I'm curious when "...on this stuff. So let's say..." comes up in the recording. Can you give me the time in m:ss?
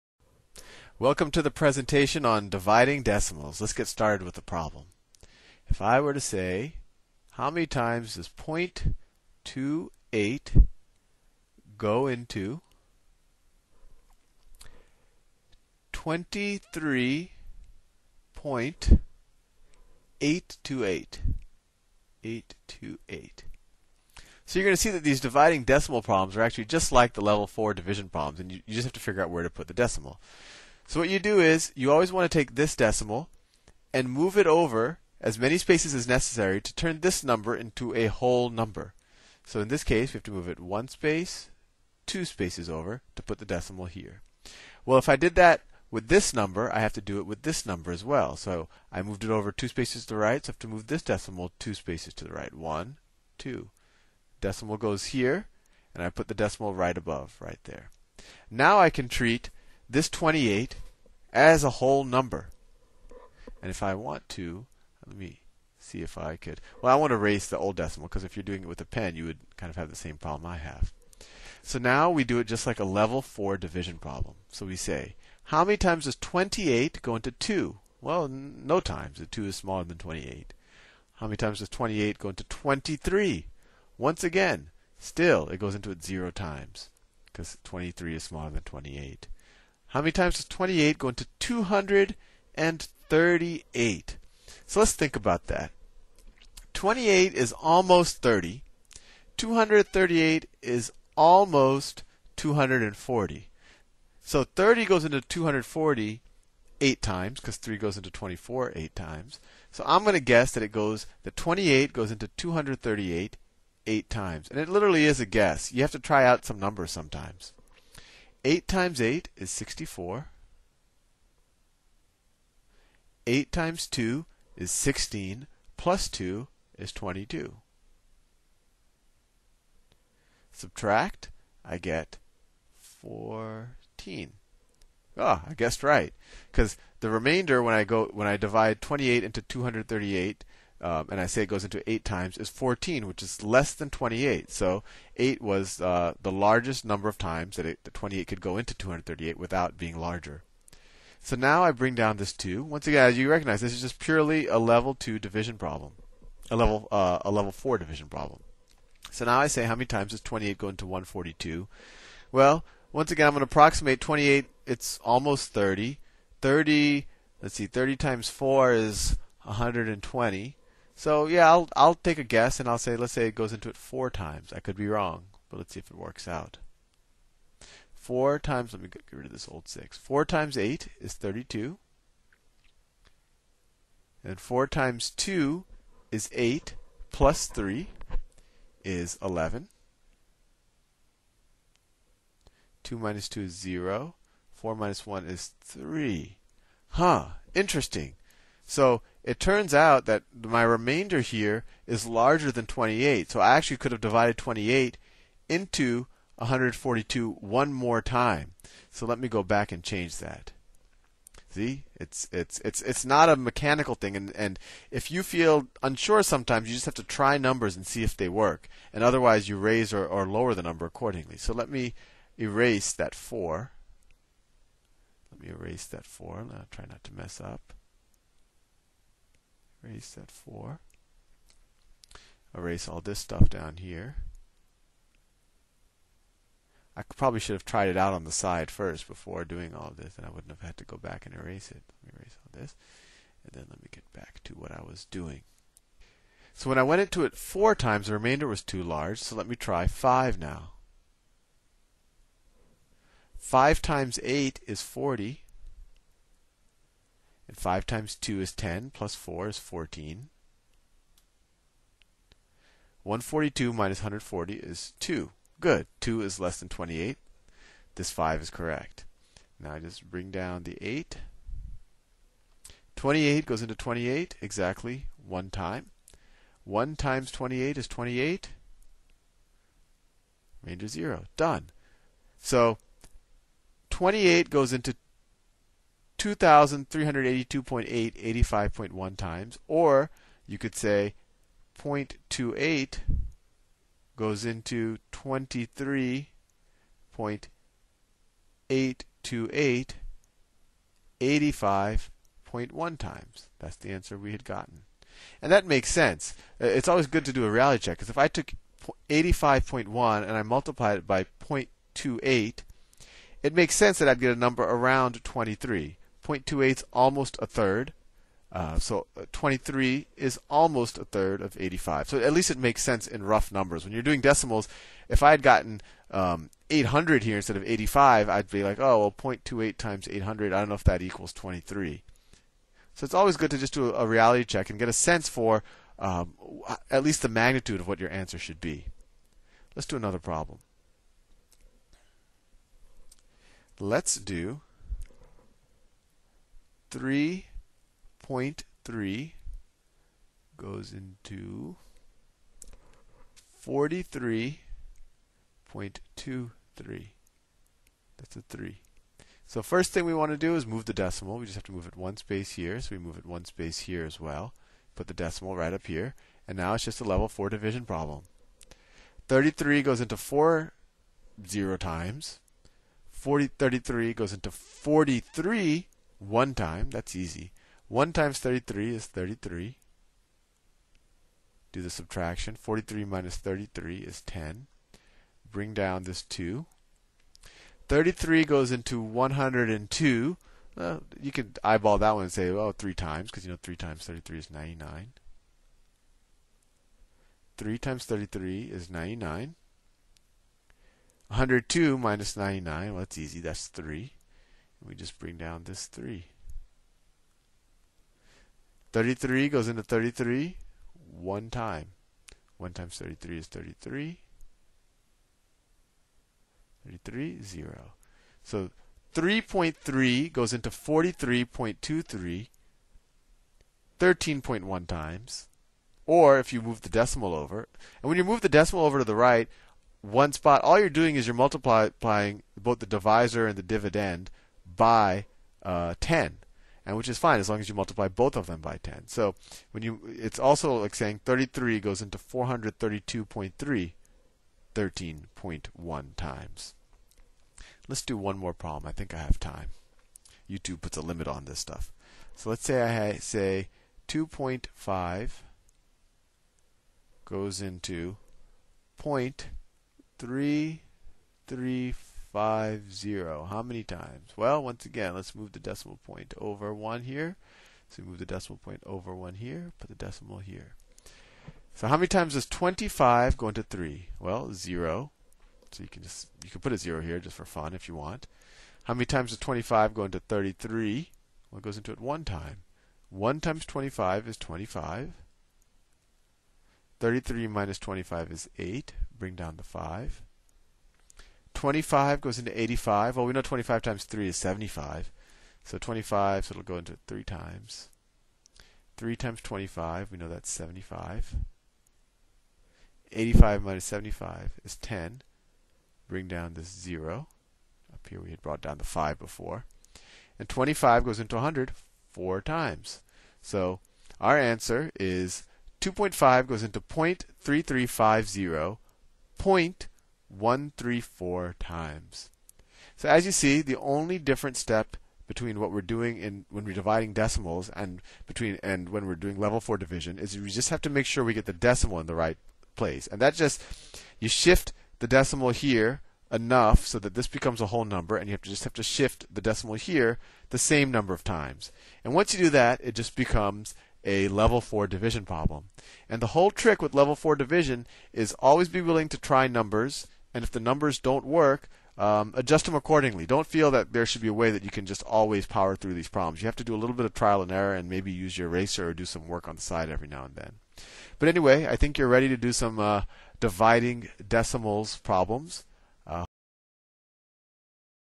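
7:31.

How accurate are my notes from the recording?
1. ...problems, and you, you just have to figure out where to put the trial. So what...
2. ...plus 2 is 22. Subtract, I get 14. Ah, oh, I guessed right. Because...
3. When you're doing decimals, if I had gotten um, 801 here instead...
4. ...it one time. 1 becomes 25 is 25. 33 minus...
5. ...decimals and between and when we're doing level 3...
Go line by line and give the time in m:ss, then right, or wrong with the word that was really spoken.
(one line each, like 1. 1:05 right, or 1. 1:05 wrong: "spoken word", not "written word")
1. 0:28 wrong: "decimal", not "trial"
2. 2:05 right
3. 5:23 wrong: "800", not "801"
4. 8:01 wrong: "times", not "becomes"
5. 8:47 wrong: "4", not "3".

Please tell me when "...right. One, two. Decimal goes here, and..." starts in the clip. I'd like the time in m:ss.
0:52.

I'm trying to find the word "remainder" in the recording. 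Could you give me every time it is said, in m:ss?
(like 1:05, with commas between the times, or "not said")
2:17, 3:20, 4:08.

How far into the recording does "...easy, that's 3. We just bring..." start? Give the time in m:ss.
6:43.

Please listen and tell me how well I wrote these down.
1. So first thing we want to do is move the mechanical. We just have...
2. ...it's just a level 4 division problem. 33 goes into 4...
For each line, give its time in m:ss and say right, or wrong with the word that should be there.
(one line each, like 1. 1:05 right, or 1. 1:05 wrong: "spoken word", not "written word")
1. 5:59 wrong: "decimal", not "mechanical"
2. 6:06 right.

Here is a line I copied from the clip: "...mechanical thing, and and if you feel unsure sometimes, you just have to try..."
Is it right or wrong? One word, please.
right.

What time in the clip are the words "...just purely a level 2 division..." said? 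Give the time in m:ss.
2:33.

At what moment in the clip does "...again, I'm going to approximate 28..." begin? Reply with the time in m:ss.
2:43.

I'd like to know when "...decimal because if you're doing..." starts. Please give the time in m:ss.
1:07.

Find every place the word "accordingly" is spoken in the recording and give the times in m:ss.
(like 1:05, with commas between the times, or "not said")
3:40, 9:12.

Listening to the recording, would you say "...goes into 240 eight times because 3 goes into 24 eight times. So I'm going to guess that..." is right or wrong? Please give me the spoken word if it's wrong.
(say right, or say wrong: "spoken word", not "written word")
right.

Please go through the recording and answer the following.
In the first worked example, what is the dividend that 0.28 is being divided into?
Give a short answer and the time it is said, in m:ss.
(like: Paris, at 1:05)
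23.828, at 0:15.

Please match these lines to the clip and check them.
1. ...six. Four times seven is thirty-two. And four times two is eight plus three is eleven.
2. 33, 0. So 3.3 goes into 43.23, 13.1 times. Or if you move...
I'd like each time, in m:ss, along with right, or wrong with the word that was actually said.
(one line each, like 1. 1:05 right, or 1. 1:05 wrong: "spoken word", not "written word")
1. 2:59 wrong: "eight", not "seven"
2. 6:56 right.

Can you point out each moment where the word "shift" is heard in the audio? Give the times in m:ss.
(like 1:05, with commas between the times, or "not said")
8:54, 8:58.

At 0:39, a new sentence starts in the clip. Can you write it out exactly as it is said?
So in this case, we have to move it one space, two spaces over to put the decimal here.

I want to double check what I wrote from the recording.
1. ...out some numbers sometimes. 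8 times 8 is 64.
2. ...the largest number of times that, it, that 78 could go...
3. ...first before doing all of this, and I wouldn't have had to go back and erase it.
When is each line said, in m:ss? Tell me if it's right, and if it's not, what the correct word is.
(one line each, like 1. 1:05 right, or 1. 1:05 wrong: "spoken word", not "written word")
1. 1:56 right
2. 2:26 wrong: "28", not "78"
3. 3:58 right.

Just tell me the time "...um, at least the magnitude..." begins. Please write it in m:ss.
5:35.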